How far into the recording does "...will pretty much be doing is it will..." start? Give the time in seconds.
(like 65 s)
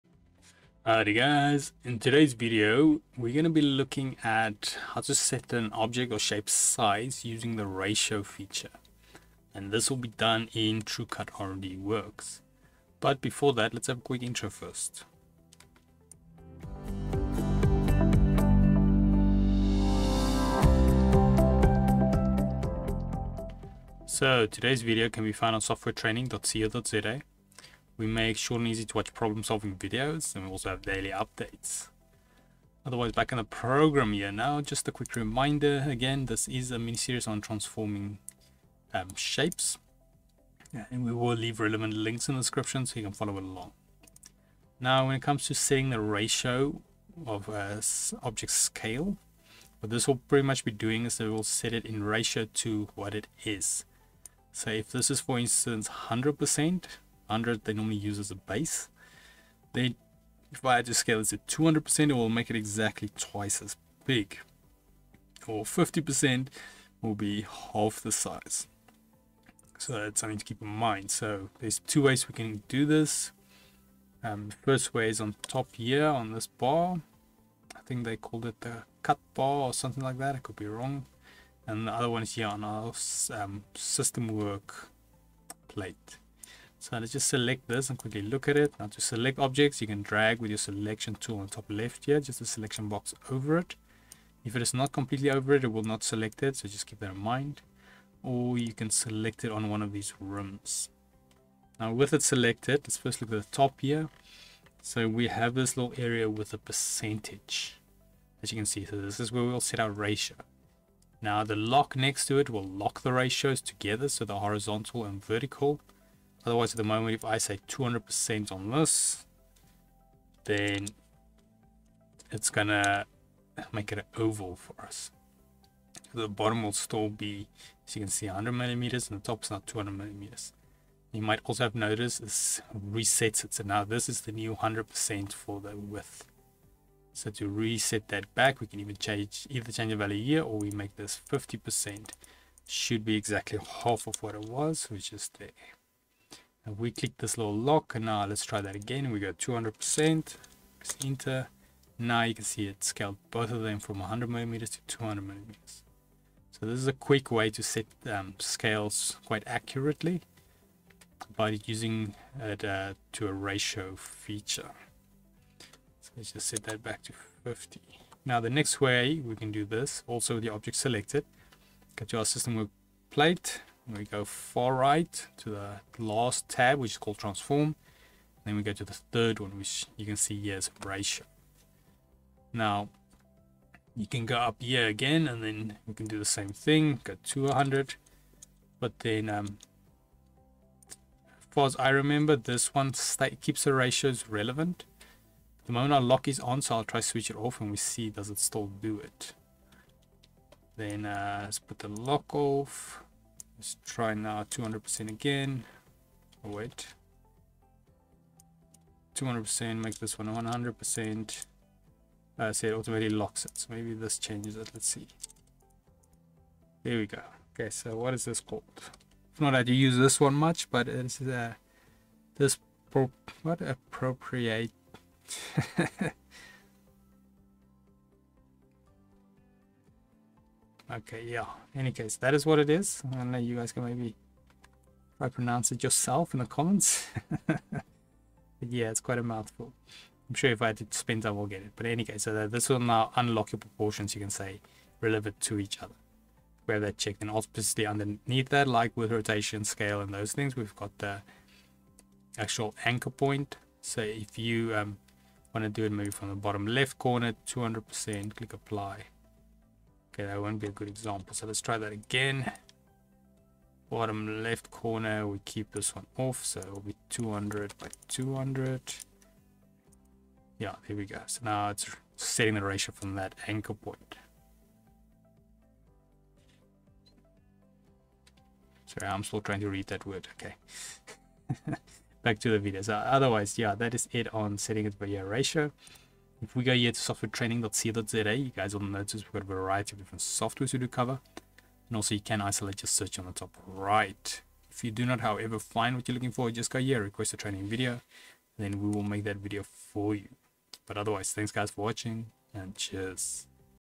50 s.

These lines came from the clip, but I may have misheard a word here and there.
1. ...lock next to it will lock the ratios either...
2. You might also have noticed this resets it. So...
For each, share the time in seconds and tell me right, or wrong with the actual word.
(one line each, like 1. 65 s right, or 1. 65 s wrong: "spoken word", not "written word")
1. 111 s wrong: "together", not "either"
2. 131 s right.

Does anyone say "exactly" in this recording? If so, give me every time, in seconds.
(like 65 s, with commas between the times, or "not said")
62 s, 143 s.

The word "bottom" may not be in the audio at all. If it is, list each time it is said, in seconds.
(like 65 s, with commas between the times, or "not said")
126 s, 256 s, 263 s.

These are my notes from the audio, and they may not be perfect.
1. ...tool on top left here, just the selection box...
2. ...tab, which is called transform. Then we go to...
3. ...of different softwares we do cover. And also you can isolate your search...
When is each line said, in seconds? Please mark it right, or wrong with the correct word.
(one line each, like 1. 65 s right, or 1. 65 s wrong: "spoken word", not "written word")
1. 91 s right
2. 176 s right
3. 289 s right.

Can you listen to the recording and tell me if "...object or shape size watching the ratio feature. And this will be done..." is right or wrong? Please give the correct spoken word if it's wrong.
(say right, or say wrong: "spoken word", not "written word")
wrong: "using", not "watching".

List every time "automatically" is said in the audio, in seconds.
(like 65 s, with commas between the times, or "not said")
212 s.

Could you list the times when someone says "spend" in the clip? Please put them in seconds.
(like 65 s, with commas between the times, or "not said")
240 s.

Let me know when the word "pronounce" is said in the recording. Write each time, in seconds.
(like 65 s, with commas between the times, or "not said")
235 s.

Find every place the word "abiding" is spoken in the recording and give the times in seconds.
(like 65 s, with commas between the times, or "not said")
not said.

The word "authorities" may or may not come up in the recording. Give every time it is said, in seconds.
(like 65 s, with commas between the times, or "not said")
not said.